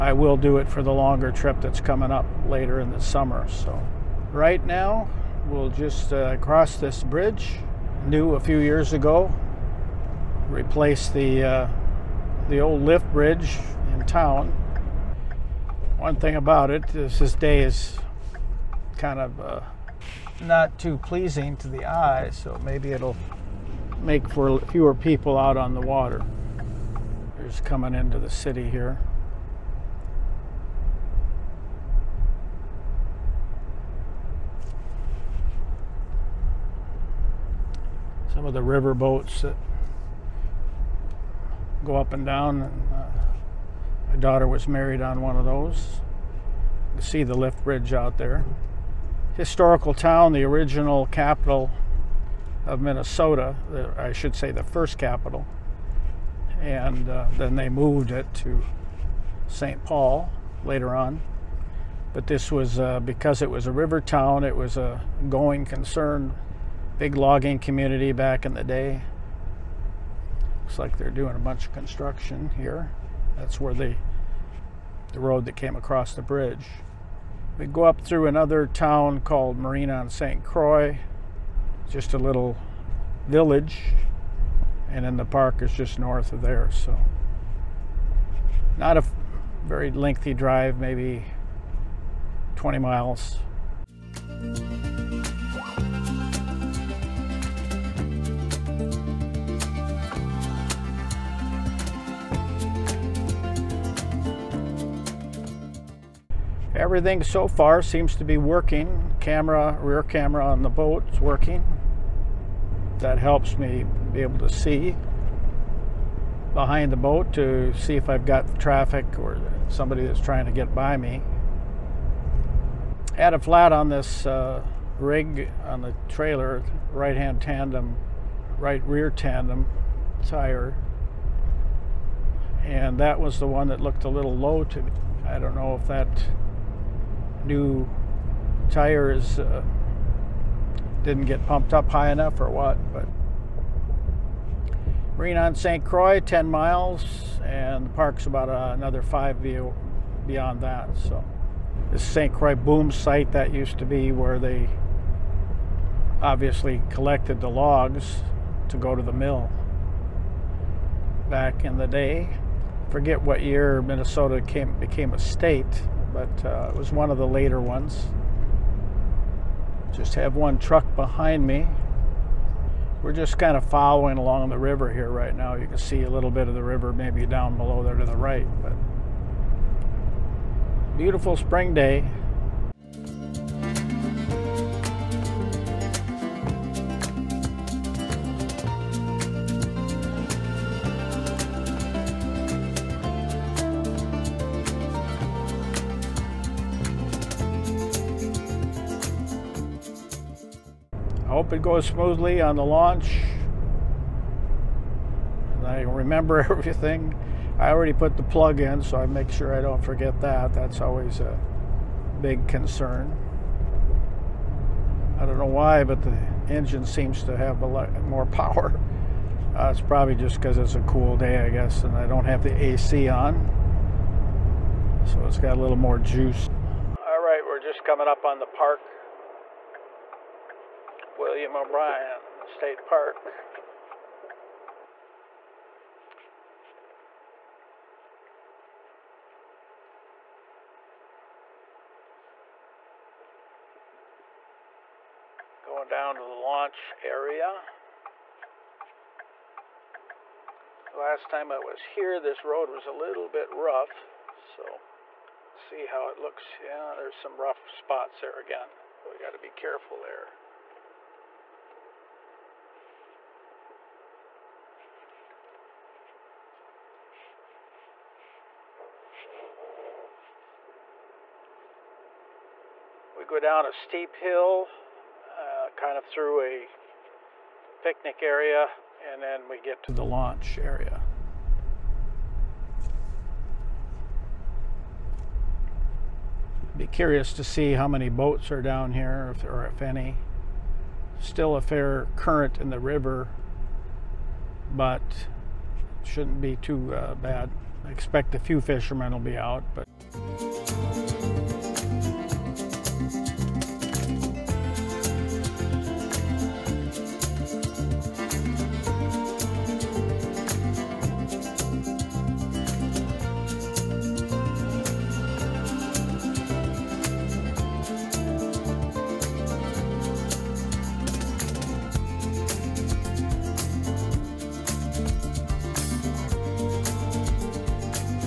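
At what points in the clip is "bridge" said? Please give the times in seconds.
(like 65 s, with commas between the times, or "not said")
7 s, 13 s, 47 s, 76 s.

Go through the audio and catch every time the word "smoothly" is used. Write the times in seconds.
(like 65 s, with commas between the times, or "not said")
201 s.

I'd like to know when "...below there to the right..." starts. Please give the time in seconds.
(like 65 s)
177 s.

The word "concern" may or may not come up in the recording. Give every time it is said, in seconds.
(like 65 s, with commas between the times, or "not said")
65 s, 212 s.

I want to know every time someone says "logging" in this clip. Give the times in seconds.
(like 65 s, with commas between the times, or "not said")
67 s.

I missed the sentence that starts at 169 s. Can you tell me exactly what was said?
Just have one truck behind me.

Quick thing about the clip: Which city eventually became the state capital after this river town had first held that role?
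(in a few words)
St. Paul.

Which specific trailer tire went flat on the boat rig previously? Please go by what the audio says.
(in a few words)
right rear tandem.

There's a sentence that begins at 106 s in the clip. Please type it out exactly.
everything so far seems to be working.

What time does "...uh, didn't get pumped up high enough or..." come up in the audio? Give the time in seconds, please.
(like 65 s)
139 s.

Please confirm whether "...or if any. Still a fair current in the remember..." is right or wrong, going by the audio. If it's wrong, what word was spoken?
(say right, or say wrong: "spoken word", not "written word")
wrong: "river", not "remember".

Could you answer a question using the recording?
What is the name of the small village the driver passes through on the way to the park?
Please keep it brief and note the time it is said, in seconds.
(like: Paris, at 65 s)
Marine on St. 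Croix, at 79 s.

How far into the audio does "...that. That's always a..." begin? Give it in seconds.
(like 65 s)
210 s.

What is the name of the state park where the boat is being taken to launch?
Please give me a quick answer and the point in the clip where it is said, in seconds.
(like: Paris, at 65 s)
William O'Brien State Park, at 231 s.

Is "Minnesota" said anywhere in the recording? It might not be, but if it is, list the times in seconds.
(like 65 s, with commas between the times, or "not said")
52 s, 163 s.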